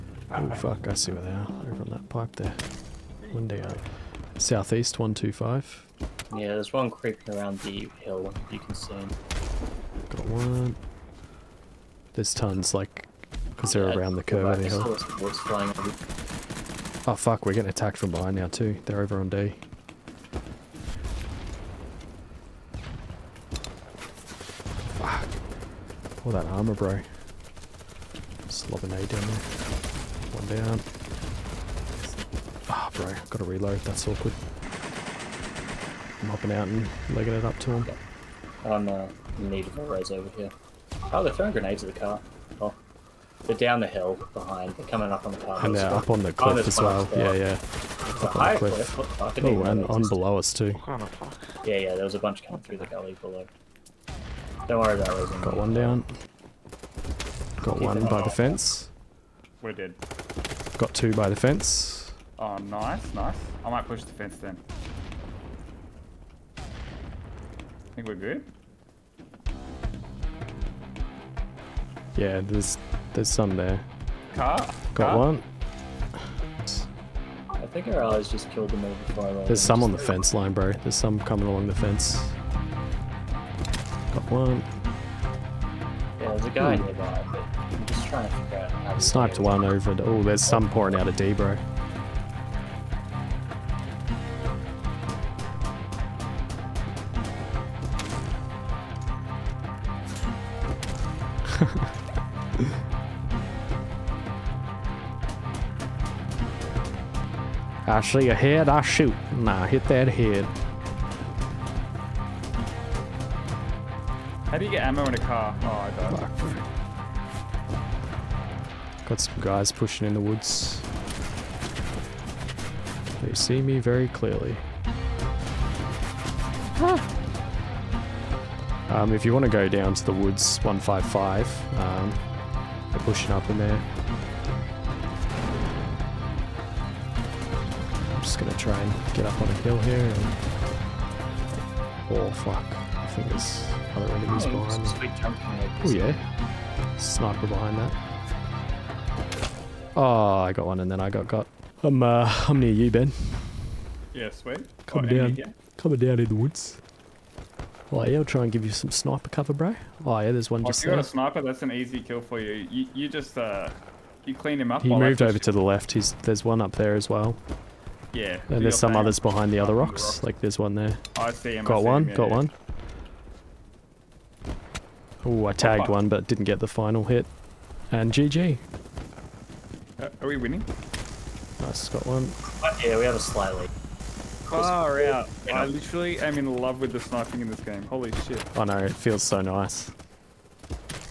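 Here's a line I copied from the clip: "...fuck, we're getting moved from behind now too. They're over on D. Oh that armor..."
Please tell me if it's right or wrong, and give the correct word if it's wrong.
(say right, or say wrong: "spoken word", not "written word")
wrong: "attacked", not "moved".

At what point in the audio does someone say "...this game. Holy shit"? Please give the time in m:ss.
3:07.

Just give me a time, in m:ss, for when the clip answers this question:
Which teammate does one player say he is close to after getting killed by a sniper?
2:32.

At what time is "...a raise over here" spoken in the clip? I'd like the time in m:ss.
0:39.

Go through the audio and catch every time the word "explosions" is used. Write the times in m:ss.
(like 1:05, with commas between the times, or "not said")
not said.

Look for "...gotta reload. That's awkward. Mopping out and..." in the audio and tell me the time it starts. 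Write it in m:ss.
0:33.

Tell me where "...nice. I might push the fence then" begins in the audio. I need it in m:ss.
1:03.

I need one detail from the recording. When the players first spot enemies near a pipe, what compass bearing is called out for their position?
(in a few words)
Southeast 125.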